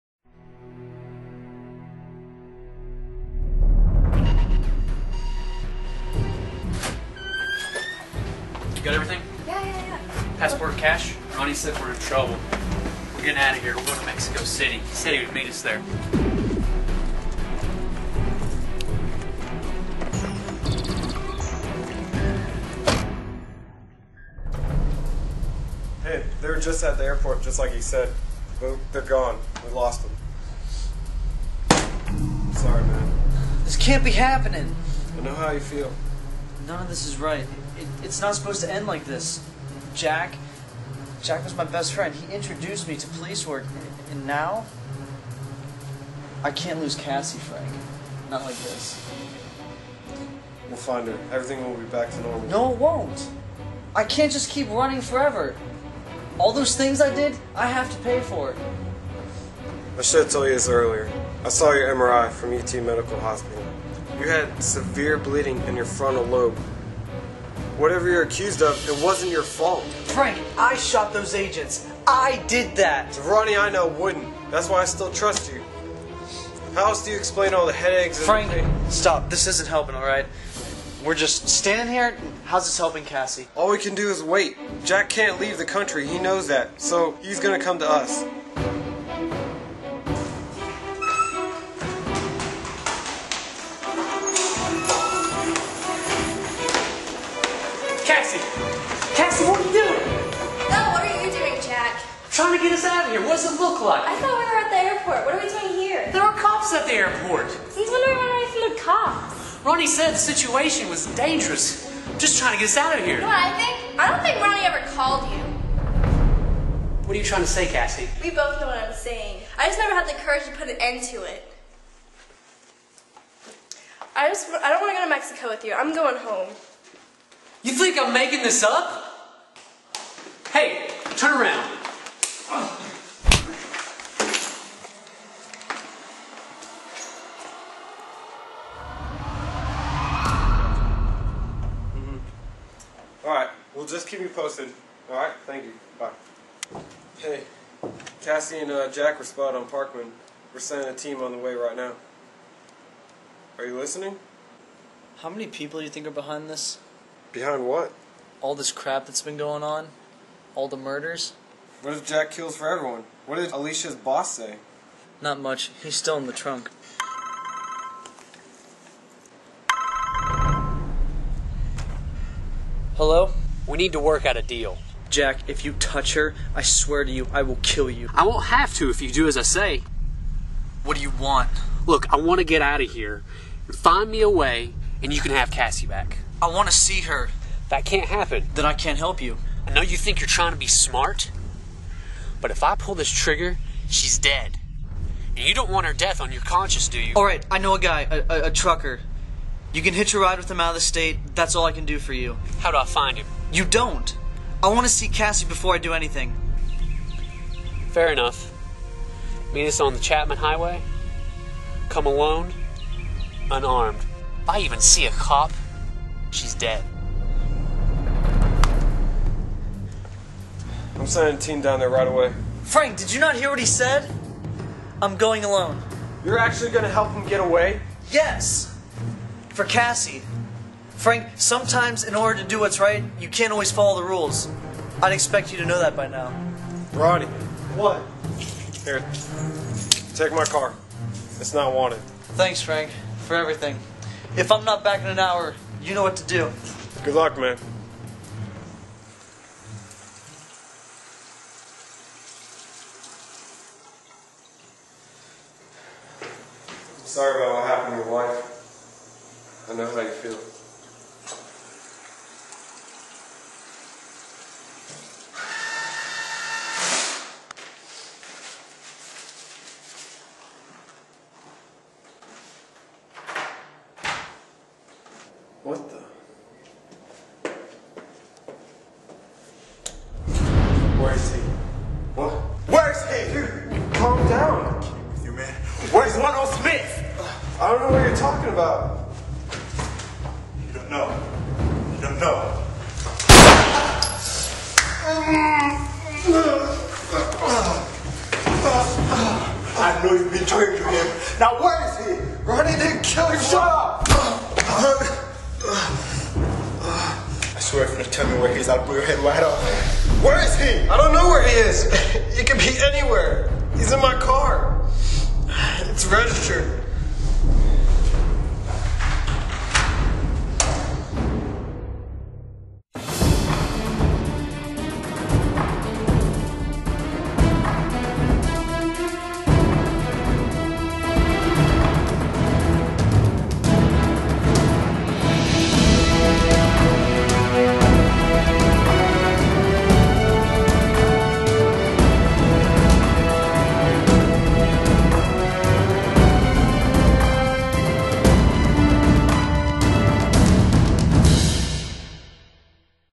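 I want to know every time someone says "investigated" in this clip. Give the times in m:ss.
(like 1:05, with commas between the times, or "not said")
not said.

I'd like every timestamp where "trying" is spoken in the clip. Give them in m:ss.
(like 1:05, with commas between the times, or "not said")
1:42, 1:52, 1:57, 3:10.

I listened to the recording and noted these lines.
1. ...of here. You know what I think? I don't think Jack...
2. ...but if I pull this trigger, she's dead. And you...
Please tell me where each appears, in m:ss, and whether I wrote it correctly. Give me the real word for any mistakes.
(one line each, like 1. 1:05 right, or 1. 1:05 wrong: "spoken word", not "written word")
1. 1:52 wrong: "Ronny", not "Jack"
2. 3:12 right.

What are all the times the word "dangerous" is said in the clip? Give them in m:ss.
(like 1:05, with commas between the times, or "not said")
1:51.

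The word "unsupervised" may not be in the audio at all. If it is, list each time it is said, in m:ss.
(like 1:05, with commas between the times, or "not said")
not said.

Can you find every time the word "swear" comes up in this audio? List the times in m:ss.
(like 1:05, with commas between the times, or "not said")
2:56, 5:07.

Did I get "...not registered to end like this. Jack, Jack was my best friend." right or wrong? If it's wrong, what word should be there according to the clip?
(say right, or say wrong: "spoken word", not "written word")
wrong: "supposed", not "registered".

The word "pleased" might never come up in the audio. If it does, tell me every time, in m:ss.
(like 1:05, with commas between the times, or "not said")
not said.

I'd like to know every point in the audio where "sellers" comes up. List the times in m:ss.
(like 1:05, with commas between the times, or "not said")
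not said.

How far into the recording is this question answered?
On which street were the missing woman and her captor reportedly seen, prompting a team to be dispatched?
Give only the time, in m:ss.
2:29.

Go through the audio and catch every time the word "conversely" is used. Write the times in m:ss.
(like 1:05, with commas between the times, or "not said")
not said.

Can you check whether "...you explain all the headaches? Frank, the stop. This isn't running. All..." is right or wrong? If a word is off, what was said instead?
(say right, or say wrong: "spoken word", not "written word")
wrong: "helping", not "running".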